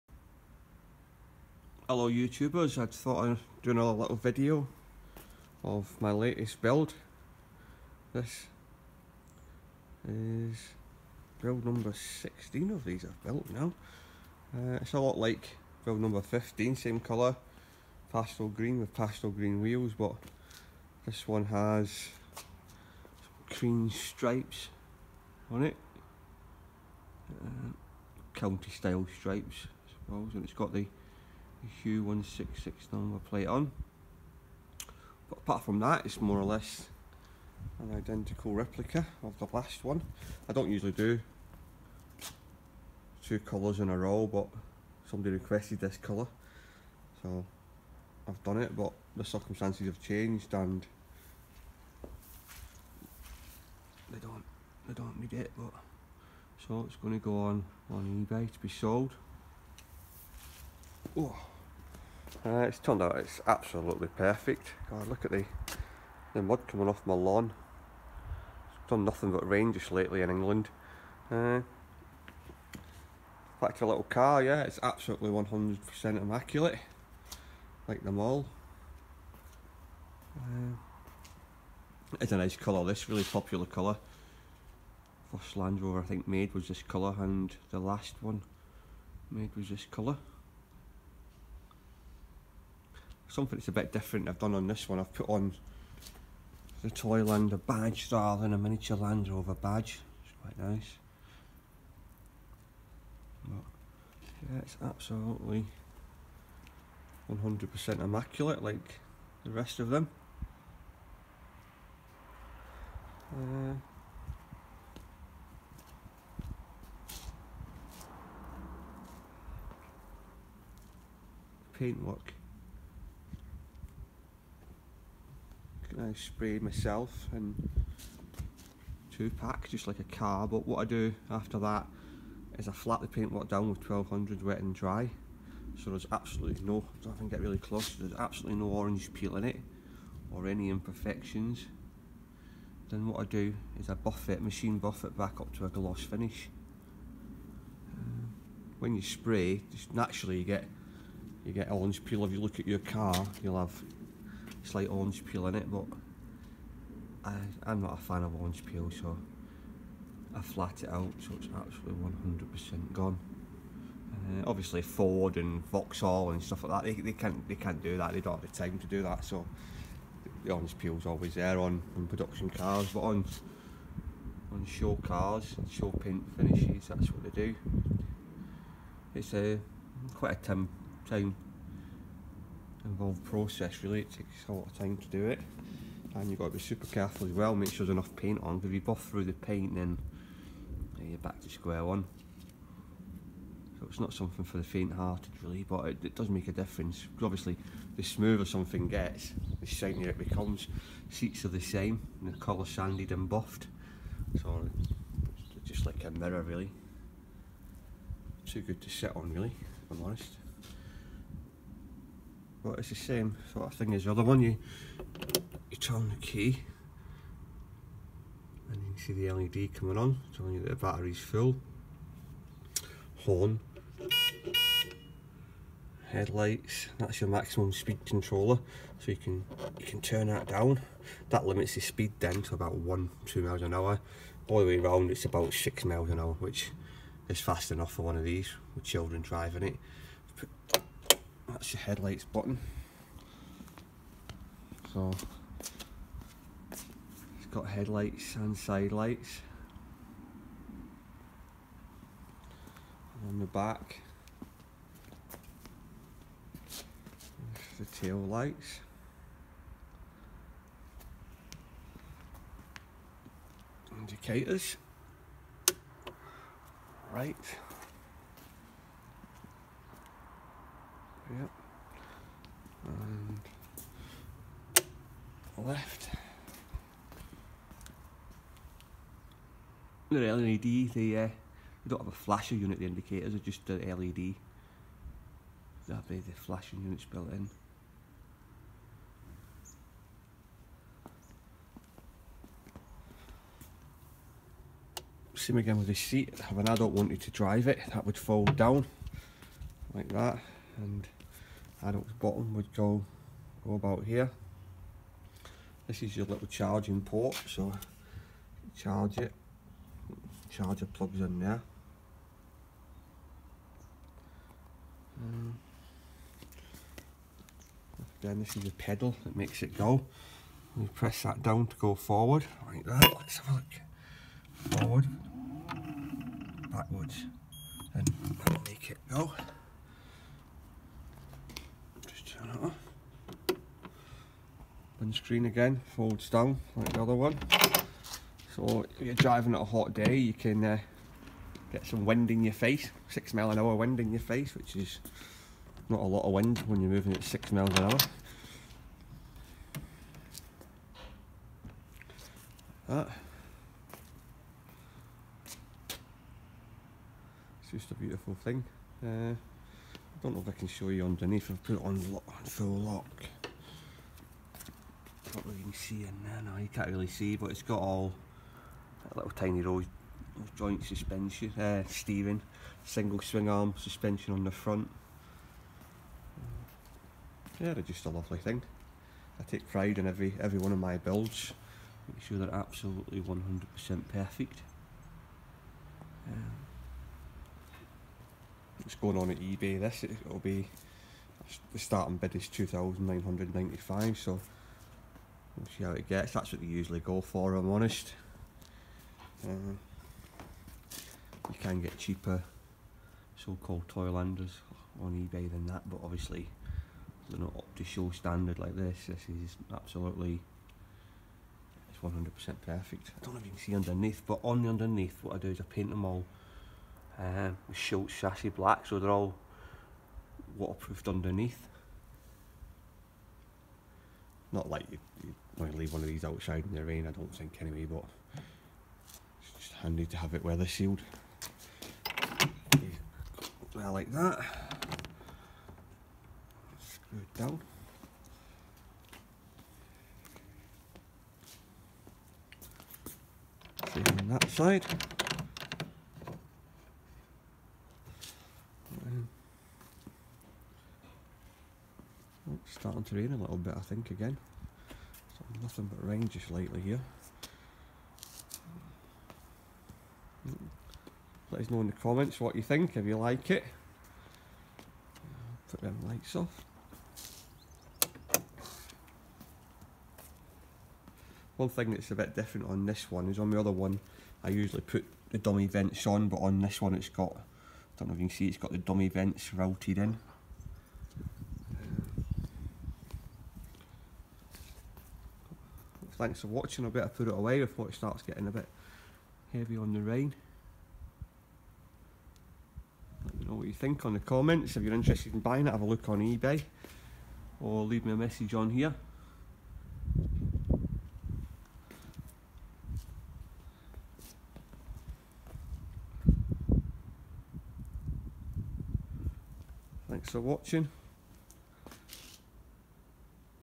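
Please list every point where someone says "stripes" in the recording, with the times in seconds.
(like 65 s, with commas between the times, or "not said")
23 s, 29 s.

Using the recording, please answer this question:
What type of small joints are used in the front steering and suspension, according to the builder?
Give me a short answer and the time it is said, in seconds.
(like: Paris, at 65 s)
rose joint, at 369 s.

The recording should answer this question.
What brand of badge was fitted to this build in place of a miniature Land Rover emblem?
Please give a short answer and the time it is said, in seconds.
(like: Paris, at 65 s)
Toylander, at 96 s.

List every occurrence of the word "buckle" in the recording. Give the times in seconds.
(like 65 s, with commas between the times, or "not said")
not said.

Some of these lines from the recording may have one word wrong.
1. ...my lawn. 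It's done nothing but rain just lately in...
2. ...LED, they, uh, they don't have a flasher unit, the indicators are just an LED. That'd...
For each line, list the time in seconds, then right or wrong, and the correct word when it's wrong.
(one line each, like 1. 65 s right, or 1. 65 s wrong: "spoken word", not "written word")
1. 67 s right
2. 280 s right.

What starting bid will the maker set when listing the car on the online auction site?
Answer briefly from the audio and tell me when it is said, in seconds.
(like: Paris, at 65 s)
2,995, at 392 s.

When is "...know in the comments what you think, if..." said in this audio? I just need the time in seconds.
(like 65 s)
461 s.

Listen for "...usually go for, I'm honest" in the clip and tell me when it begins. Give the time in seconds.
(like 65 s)
396 s.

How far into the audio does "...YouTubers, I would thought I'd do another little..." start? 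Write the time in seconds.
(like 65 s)
2 s.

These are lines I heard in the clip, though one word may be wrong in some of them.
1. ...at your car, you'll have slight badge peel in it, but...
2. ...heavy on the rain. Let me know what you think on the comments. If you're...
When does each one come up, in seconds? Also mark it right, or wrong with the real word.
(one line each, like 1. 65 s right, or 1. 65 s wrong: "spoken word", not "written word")
1. 152 s wrong: "orange", not "badge"
2. 489 s right.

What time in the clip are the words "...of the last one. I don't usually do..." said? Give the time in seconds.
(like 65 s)
39 s.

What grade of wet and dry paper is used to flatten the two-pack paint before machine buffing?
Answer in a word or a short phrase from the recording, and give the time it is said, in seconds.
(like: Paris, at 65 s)
1200, at 133 s.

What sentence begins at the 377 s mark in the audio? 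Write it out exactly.
Yeah, they're just a lovely thing.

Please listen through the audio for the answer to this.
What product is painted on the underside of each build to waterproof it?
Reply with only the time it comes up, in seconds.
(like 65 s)
417 s.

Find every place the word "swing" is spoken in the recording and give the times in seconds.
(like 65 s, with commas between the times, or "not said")
373 s.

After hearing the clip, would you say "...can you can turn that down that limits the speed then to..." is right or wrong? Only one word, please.
right.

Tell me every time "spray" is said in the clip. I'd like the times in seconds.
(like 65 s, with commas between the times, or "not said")
126 s, 149 s.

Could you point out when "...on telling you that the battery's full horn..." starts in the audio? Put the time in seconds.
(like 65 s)
219 s.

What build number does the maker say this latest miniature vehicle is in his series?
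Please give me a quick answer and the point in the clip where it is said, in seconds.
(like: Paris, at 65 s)
16, at 11 s.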